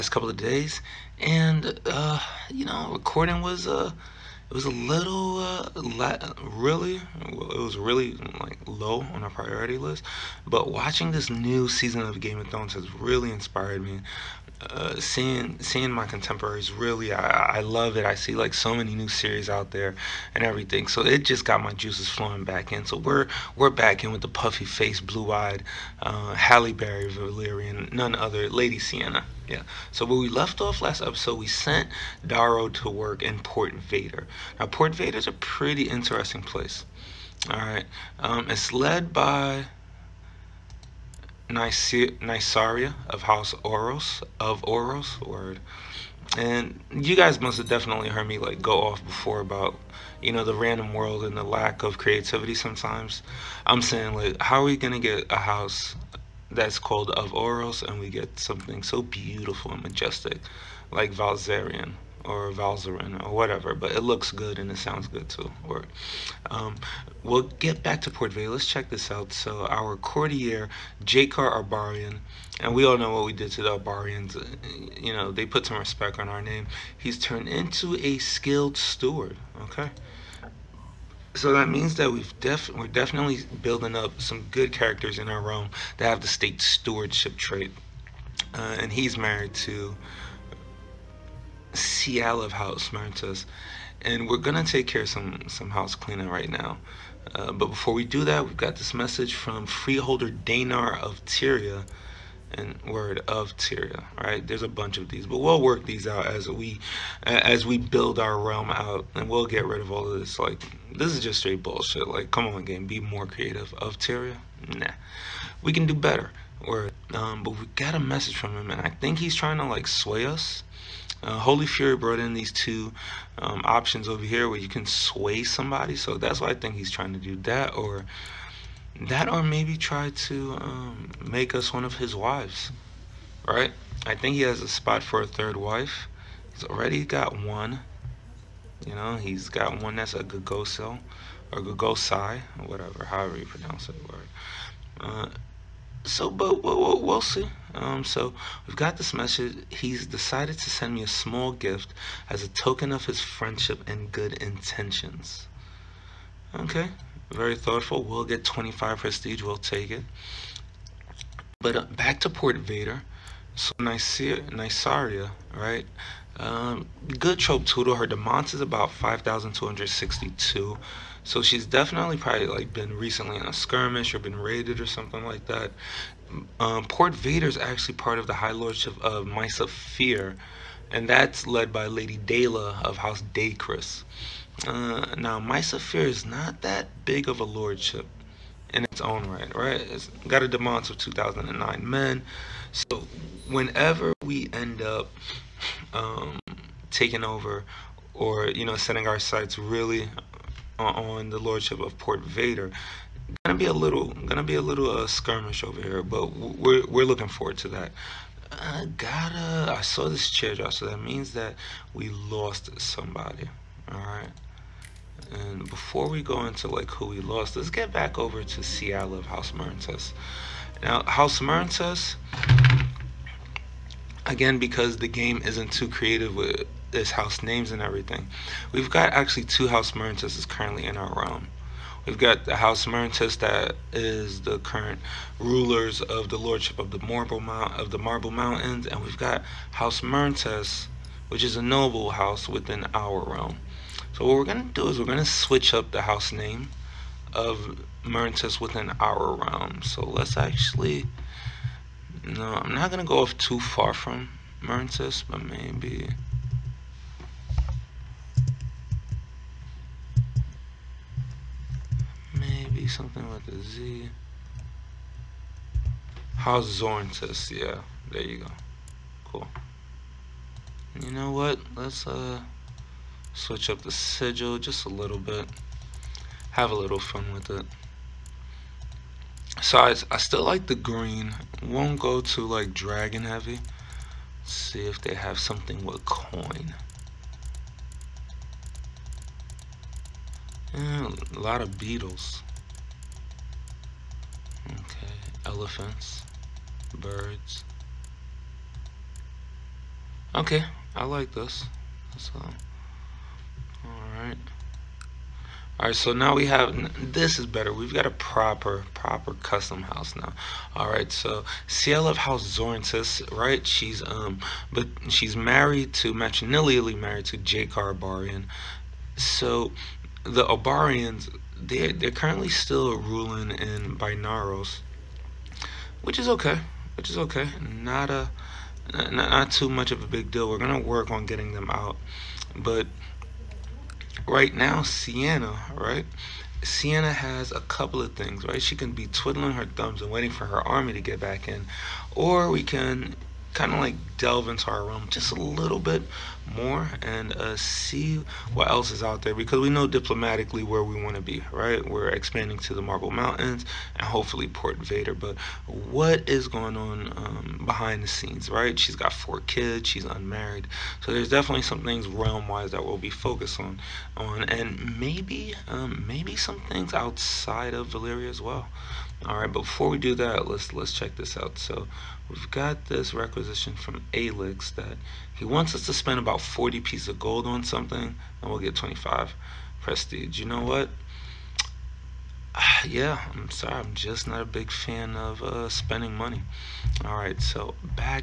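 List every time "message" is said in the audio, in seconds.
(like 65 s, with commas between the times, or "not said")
98 s, 117 s, 149 s.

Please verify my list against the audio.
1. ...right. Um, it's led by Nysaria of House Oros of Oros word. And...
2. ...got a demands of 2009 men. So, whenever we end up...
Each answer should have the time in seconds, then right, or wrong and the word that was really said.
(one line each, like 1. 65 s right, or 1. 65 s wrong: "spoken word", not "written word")
1. 37 s right
2. 190 s right.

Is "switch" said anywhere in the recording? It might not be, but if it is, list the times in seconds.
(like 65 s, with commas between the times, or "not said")
245 s, 273 s.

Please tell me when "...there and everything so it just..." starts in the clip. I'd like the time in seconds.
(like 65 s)
19 s.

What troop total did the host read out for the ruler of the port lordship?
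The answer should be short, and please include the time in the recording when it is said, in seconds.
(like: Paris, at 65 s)
5,262, at 168 s.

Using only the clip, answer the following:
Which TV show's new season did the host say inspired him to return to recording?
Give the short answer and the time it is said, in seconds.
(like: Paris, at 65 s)
Game of Thrones, at 12 s.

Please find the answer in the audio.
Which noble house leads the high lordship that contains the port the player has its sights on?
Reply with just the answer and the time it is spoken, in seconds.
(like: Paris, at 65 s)
House Dacris, at 182 s.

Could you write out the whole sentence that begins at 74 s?
Eh, you know, they put some respect on our name.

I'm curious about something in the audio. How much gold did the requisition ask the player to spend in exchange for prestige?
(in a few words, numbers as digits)
40.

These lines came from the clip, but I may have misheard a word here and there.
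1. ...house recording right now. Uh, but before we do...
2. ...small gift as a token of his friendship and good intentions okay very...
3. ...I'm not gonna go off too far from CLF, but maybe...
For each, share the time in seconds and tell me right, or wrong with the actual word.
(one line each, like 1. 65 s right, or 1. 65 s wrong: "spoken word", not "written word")
1. 95 s wrong: "cleaning", not "recording"
2. 151 s right
3. 252 s wrong: "Myrtus", not "CLF".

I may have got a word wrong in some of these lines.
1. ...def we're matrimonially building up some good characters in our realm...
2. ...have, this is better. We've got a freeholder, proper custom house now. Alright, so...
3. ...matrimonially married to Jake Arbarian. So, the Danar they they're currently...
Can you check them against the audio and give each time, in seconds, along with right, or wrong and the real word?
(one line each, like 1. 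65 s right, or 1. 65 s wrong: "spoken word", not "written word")
1. 82 s wrong: "definitely", not "matrimonially"
2. 306 s wrong: "proper", not "freeholder"
3. 316 s wrong: "Obarians", not "Danar".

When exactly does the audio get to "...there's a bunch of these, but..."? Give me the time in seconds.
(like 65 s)
104 s.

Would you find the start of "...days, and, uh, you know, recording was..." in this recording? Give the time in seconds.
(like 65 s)
0 s.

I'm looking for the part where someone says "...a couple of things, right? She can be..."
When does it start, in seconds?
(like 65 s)
337 s.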